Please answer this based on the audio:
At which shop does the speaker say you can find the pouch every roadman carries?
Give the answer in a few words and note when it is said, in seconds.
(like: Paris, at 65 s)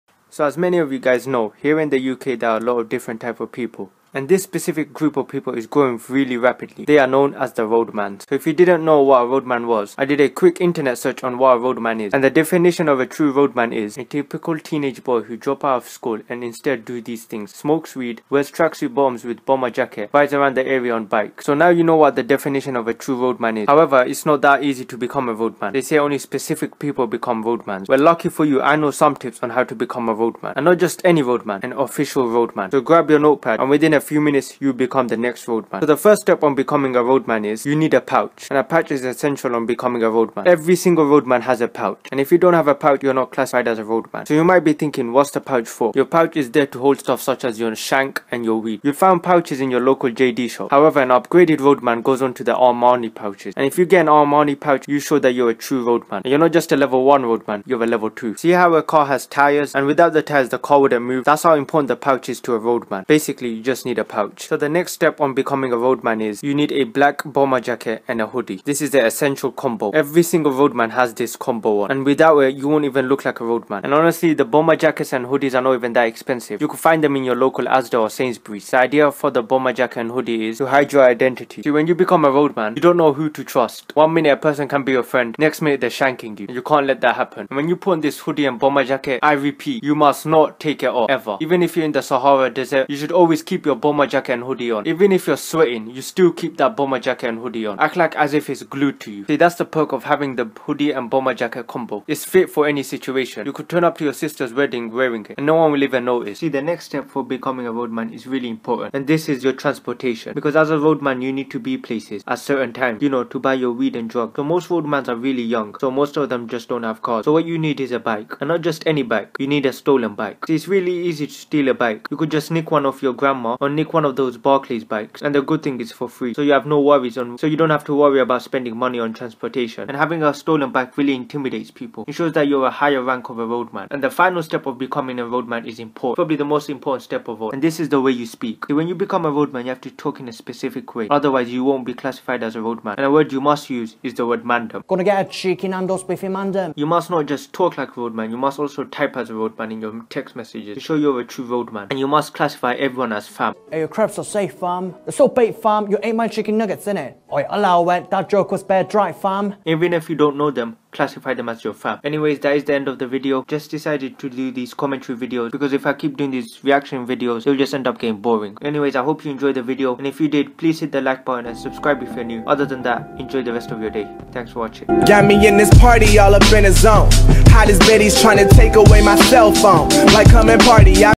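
JD, at 50 s.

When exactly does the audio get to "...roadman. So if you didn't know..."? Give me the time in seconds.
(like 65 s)
7 s.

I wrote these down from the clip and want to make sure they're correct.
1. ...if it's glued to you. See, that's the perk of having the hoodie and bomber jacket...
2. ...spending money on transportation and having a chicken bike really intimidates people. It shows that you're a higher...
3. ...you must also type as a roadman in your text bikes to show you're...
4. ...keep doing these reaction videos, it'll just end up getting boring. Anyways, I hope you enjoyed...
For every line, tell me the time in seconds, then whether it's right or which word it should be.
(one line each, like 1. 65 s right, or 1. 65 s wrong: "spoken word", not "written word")
1. 98 s right
2. 128 s wrong: "stolen", not "chicken"
3. 148 s wrong: "messages", not "bikes"
4. 165 s right.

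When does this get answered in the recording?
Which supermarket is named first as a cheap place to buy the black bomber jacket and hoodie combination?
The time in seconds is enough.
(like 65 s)
77 s.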